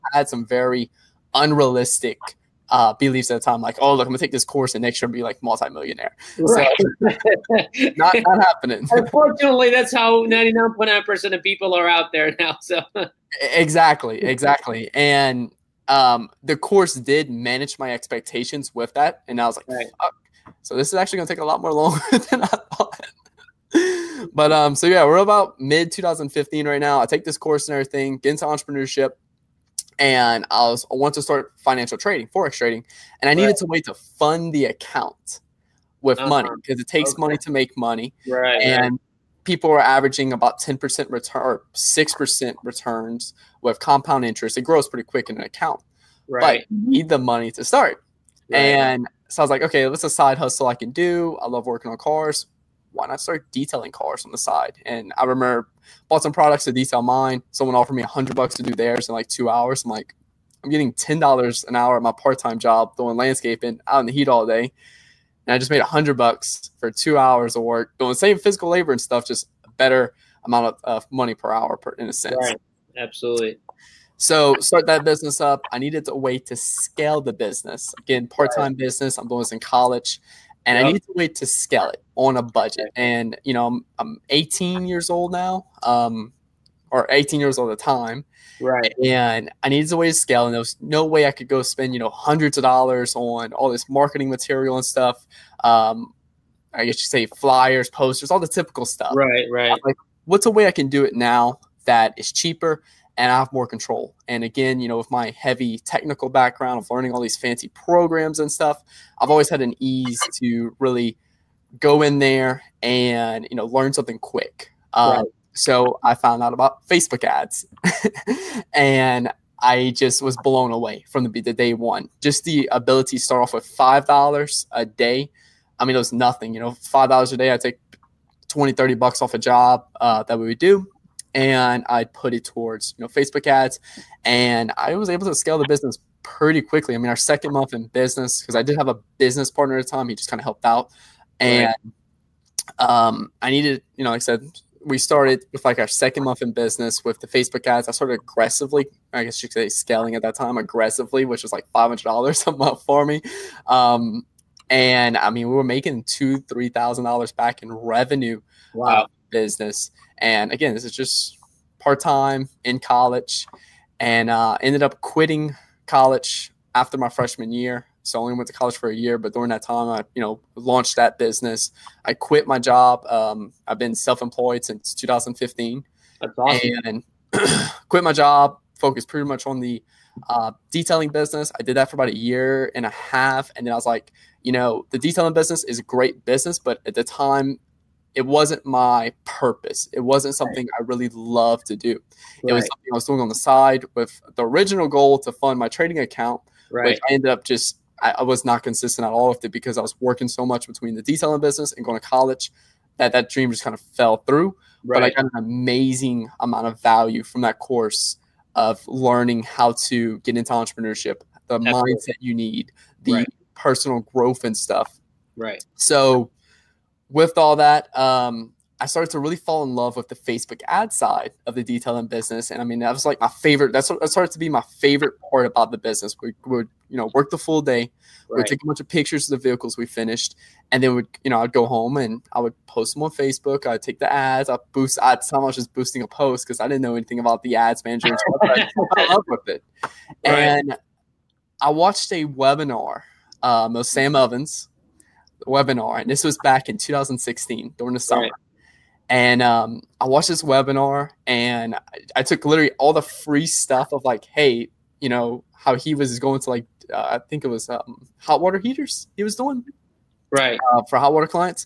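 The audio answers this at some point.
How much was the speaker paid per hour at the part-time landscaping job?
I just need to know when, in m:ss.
1:00.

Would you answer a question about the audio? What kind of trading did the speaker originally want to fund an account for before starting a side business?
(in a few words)
forex trading.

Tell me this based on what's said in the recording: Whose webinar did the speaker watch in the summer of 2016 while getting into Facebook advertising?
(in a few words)
Sam Ovens.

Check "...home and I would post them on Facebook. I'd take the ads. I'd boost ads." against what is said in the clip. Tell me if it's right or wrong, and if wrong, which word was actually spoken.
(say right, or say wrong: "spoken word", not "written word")
right.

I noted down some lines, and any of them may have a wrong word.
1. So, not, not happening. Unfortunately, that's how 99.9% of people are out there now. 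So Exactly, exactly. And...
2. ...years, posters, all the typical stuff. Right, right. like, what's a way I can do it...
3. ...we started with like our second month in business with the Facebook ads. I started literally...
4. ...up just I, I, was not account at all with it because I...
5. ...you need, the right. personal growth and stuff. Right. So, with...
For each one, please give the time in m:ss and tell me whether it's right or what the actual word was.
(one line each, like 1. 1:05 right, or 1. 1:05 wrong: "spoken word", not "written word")
1. 0:06 right
2. 1:37 wrong: "flyers", not "years"
3. 2:24 wrong: "aggressively", not "literally"
4. 3:17 wrong: "consistent", not "account"
5. 3:32 right.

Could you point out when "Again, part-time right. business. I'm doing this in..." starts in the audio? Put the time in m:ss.
1:17.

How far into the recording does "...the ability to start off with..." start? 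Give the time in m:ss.
2:02.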